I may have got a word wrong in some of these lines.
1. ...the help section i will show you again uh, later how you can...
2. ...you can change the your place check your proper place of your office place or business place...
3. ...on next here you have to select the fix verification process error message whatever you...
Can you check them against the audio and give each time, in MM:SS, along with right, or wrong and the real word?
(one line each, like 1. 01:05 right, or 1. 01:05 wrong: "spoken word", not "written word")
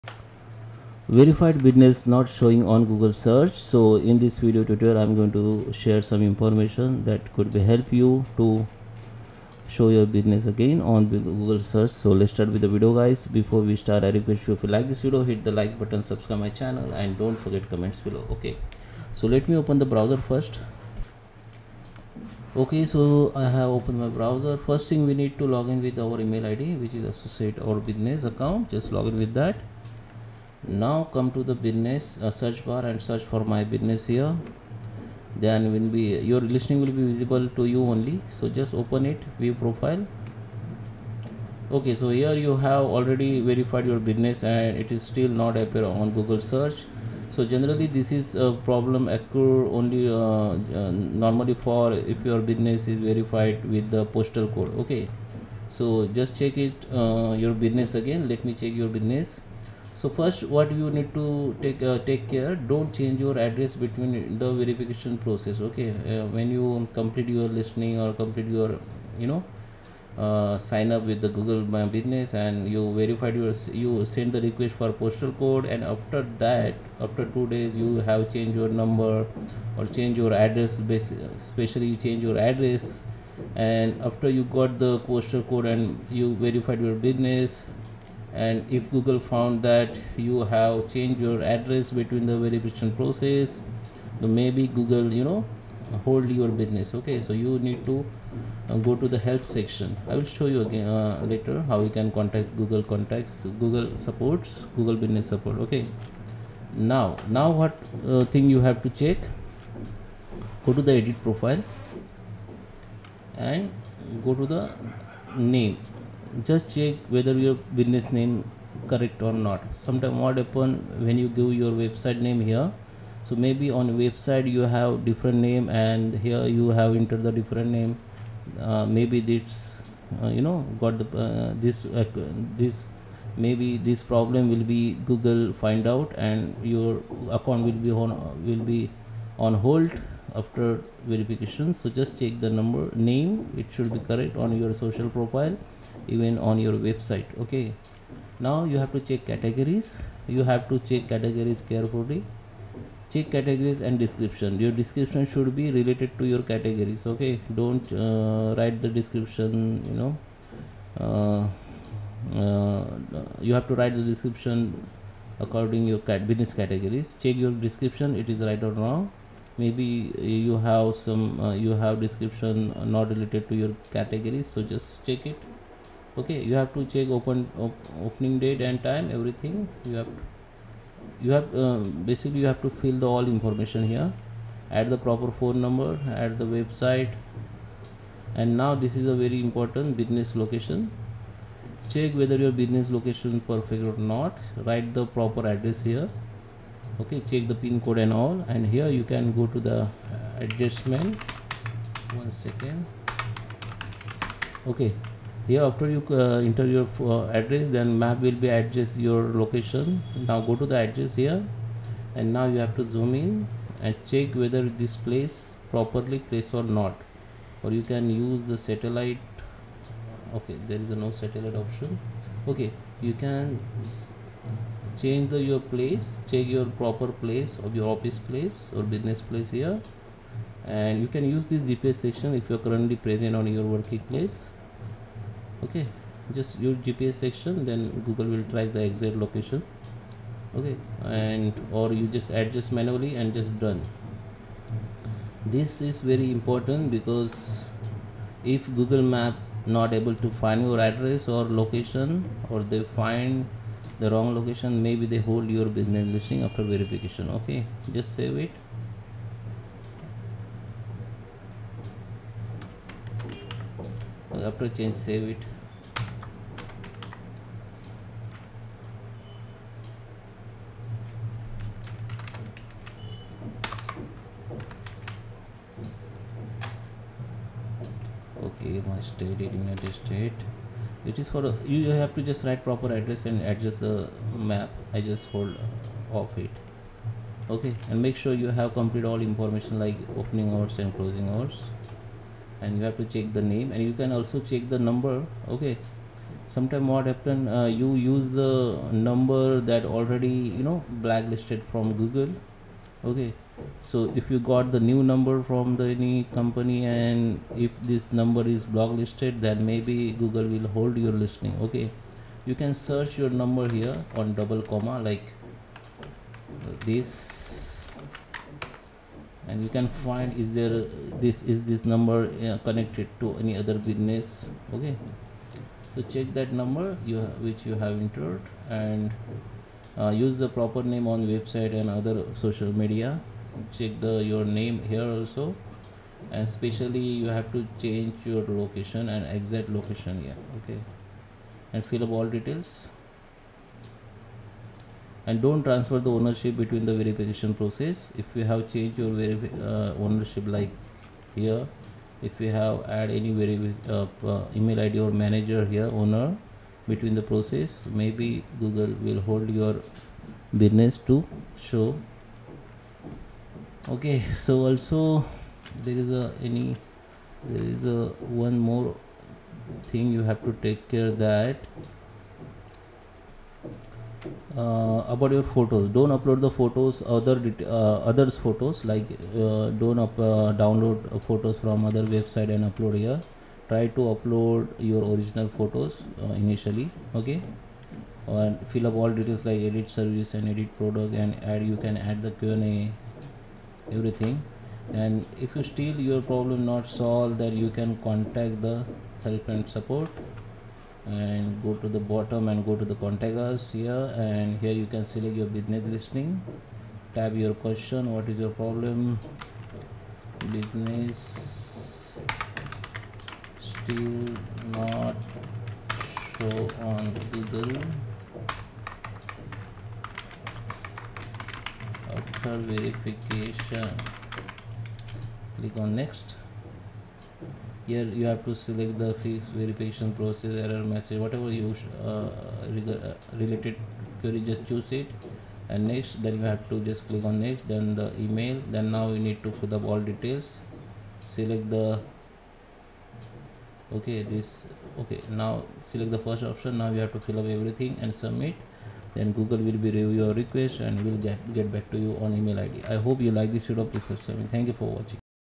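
1. 01:39 right
2. 03:43 right
3. 07:05 right.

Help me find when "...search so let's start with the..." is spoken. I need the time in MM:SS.
00:11.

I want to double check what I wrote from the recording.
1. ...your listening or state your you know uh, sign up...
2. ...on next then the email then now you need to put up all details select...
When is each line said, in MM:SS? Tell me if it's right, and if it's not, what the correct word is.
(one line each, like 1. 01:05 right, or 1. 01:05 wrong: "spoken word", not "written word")
1. 01:07 wrong: "complete", not "state"
2. 07:17 right.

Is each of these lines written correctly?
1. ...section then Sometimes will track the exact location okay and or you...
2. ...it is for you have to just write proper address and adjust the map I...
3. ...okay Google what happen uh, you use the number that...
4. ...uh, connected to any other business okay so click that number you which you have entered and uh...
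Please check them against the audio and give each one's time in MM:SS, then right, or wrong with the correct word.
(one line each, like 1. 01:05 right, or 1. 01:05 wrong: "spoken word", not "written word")
1. 03:57 wrong: "Google", not "Sometimes"
2. 04:41 right
3. 04:55 wrong: "Sometimes", not "Google"
4. 05:22 wrong: "check", not "click".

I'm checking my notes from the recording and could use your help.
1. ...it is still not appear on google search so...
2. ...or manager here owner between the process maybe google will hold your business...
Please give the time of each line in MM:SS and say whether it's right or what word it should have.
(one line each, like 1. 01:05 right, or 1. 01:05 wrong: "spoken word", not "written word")
1. 00:44 right
2. 05:54 right.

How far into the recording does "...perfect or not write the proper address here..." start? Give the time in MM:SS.
03:13.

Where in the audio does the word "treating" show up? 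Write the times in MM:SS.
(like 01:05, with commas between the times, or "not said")
not said.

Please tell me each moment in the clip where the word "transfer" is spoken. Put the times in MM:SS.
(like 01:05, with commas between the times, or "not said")
05:45.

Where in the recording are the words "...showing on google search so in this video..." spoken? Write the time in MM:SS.
00:02.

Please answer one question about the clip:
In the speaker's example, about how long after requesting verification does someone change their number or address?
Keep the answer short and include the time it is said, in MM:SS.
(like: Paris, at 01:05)
Two days, at 01:17.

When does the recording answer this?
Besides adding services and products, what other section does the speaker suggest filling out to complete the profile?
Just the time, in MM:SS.
06:32.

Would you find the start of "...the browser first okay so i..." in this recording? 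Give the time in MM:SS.
00:19.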